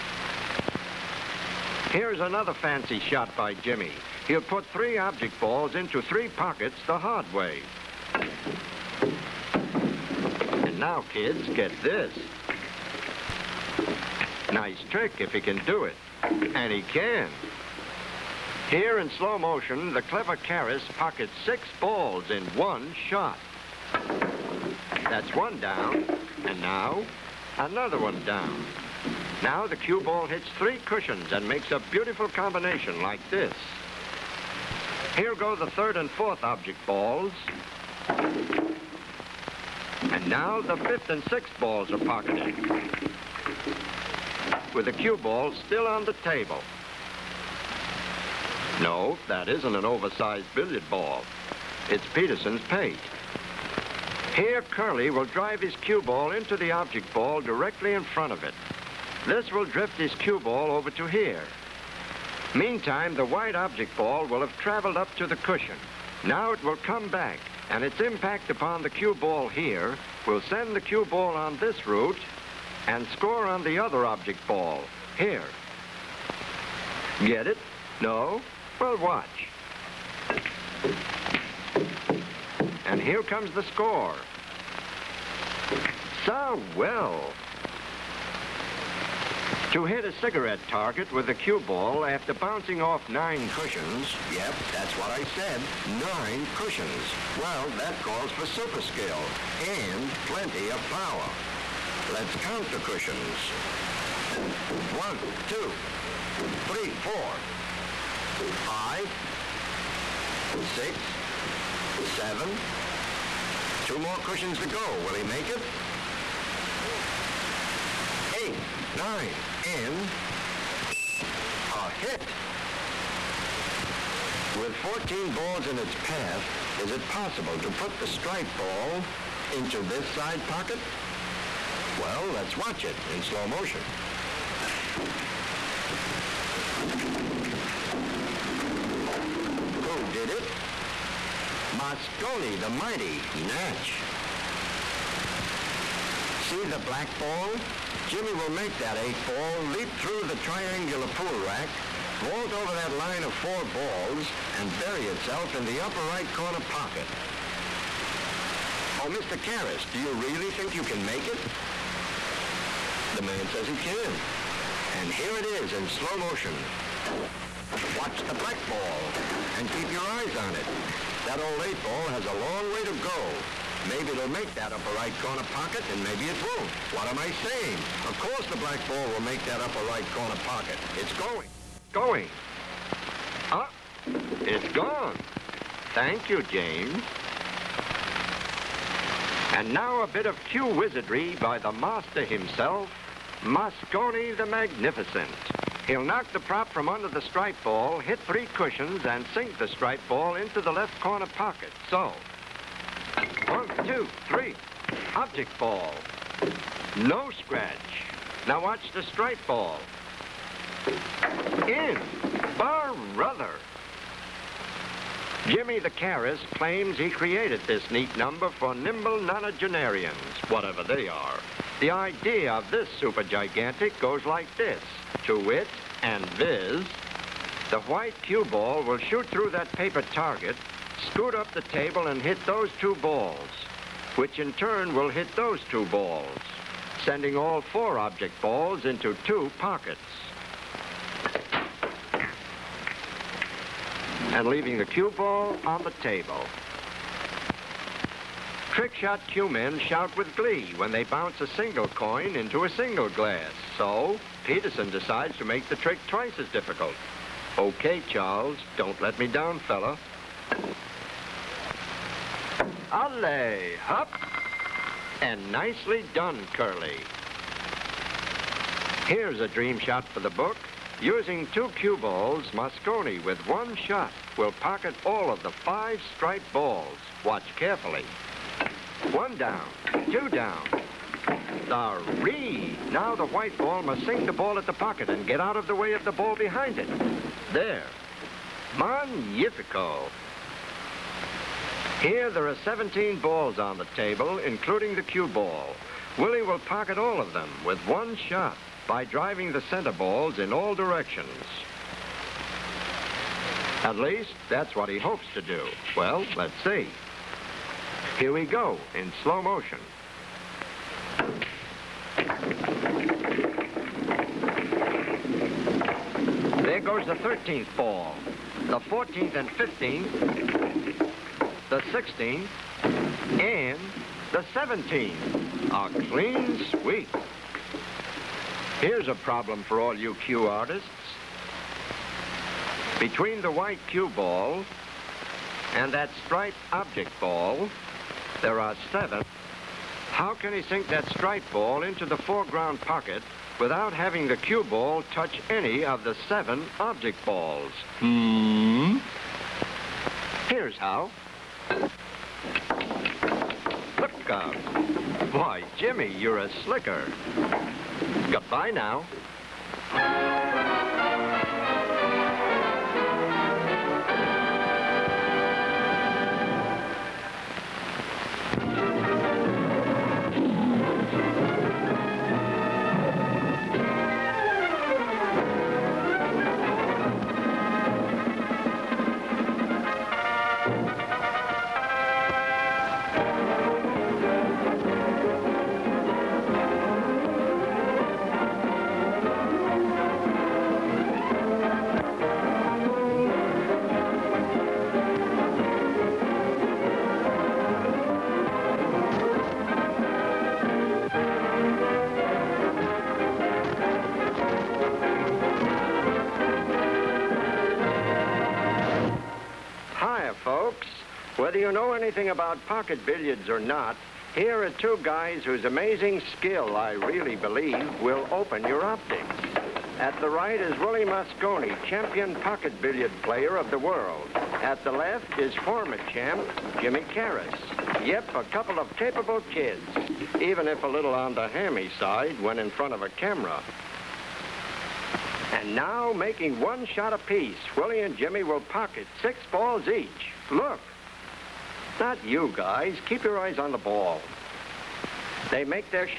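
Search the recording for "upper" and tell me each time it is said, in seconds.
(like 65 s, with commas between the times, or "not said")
155 s, 174 s, 179 s.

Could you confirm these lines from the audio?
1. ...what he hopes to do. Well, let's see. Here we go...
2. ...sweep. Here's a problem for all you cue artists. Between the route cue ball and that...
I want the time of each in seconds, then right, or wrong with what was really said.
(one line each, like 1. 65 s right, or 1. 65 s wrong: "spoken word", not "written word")
1. 304 s right
2. 326 s wrong: "white", not "route".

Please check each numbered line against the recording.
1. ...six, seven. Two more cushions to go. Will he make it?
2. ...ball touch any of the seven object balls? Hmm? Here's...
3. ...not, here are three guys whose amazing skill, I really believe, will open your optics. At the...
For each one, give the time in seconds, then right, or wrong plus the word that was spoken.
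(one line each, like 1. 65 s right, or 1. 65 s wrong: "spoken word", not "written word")
1. 110 s right
2. 344 s right
3. 413 s wrong: "two", not "three".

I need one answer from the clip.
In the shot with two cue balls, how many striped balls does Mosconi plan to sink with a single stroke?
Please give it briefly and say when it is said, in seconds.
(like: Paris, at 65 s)
5, at 275 s.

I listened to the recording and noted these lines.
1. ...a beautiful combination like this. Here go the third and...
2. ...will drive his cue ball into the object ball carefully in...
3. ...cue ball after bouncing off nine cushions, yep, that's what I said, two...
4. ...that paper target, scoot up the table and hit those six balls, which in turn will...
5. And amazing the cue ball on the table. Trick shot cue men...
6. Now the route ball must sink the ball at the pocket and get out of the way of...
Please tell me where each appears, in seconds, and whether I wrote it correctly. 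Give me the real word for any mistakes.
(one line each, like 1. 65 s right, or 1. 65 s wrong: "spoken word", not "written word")
1. 31 s right
2. 55 s wrong: "directly", not "carefully"
3. 91 s wrong: "nine", not "two"
4. 229 s wrong: "two", not "six"
5. 244 s wrong: "leaving", not "amazing"
6. 282 s wrong: "white", not "route".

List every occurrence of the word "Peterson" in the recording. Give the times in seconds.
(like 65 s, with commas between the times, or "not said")
52 s, 254 s.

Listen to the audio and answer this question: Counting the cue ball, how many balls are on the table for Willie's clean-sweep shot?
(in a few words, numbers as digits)
17.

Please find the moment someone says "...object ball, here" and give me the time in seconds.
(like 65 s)
74 s.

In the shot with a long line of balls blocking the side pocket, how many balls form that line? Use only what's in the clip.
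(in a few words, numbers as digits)
14.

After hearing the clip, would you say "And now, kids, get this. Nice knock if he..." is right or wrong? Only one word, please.
wrong.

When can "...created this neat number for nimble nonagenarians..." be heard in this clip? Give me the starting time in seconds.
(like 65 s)
217 s.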